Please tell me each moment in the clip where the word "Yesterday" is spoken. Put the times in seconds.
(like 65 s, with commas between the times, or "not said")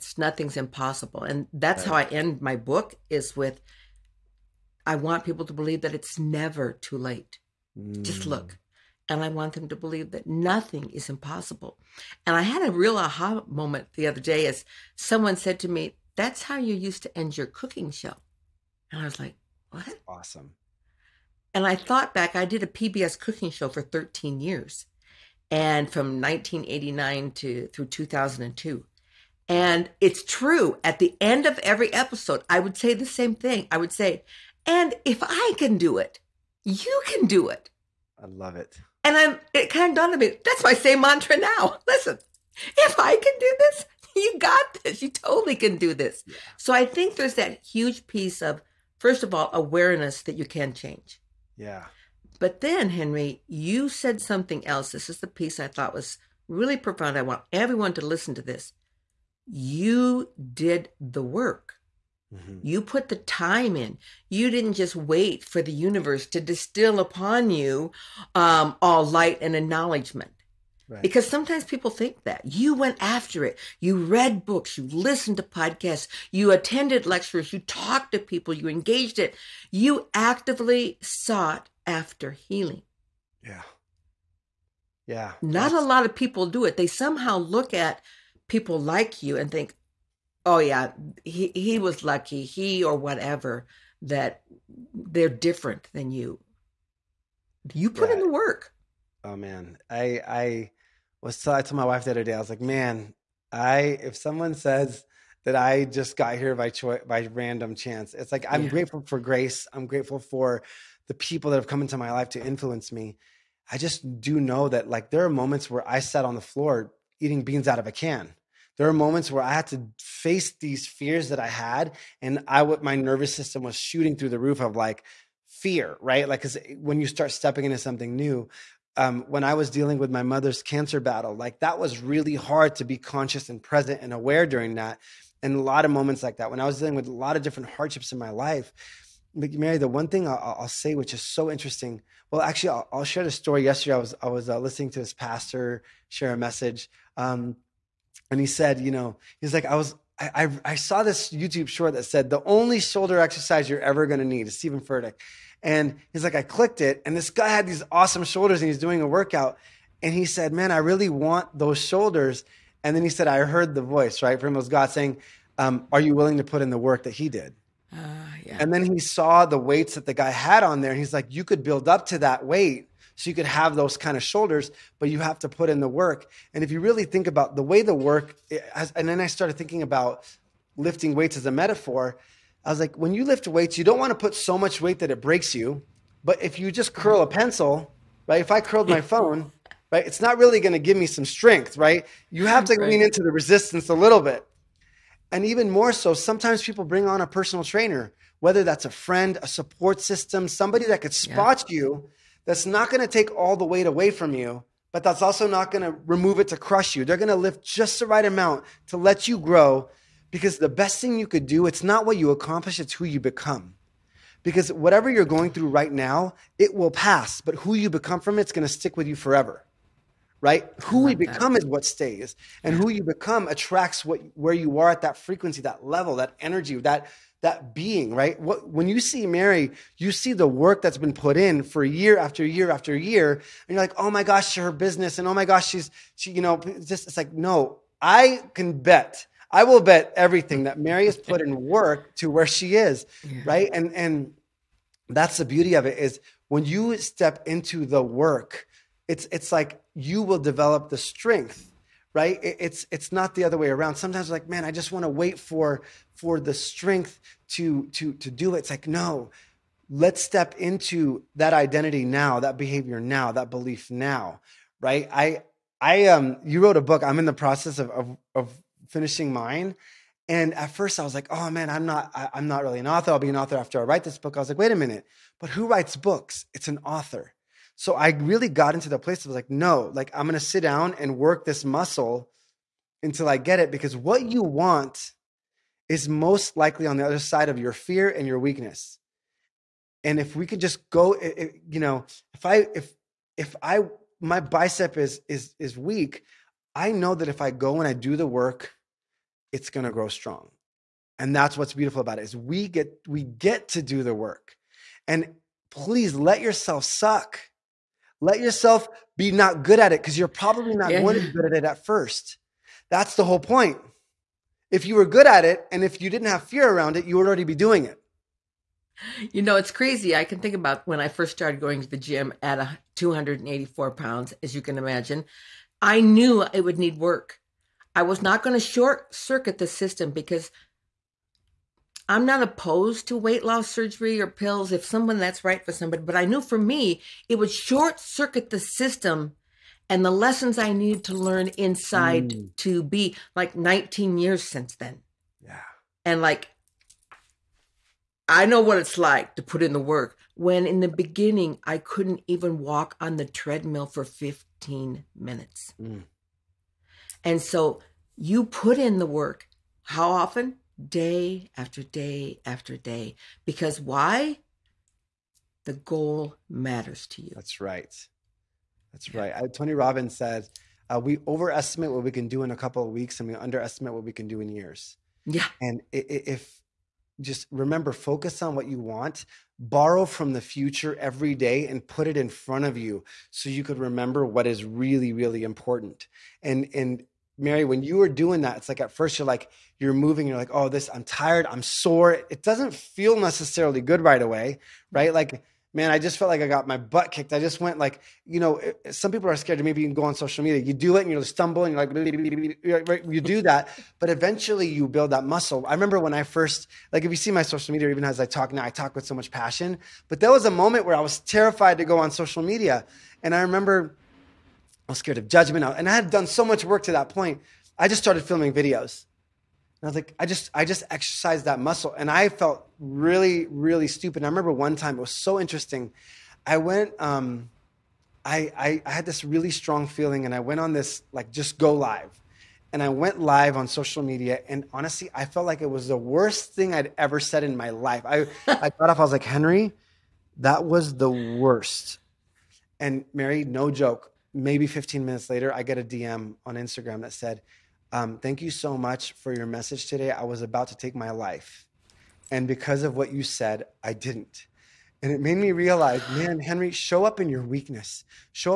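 143 s.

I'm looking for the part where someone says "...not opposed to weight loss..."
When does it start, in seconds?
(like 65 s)
332 s.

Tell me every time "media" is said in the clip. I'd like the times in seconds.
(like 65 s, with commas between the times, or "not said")
400 s, 407 s, 412 s, 434 s.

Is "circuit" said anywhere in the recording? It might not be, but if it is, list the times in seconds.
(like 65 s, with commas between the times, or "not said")
329 s, 337 s.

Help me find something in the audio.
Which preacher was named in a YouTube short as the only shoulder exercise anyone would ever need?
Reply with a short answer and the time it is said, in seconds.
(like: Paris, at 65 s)
Steven Furtick, at 154 s.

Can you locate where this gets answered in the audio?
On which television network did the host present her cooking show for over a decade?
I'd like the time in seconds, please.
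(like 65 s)
22 s.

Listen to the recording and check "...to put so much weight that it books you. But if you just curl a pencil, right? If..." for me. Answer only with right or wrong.
wrong.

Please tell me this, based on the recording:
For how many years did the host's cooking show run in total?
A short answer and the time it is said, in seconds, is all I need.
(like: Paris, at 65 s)
13, at 23 s.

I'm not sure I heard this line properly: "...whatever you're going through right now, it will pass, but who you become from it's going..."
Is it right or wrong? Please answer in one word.
right.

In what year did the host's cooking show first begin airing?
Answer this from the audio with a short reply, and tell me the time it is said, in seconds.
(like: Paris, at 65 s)
1989, at 26 s.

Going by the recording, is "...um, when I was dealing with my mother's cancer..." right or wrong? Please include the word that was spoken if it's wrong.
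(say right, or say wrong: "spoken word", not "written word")
right.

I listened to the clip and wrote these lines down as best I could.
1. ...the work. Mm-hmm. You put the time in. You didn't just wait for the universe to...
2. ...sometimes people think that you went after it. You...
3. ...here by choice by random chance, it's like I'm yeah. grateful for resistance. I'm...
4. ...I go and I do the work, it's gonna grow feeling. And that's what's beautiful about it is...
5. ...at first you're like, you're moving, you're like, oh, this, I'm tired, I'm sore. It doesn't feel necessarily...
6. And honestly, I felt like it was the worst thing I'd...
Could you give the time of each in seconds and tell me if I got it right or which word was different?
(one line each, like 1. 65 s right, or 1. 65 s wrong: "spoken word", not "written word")
1. 61 s right
2. 71 s right
3. 106 s wrong: "grace", not "resistance"
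4. 297 s wrong: "strong", not "feeling"
5. 388 s right
6. 434 s right.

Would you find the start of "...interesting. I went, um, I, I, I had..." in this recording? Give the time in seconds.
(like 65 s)
425 s.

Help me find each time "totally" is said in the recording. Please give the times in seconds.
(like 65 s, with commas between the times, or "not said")
45 s.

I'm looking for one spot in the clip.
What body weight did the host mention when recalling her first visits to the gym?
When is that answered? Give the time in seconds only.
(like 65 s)
322 s.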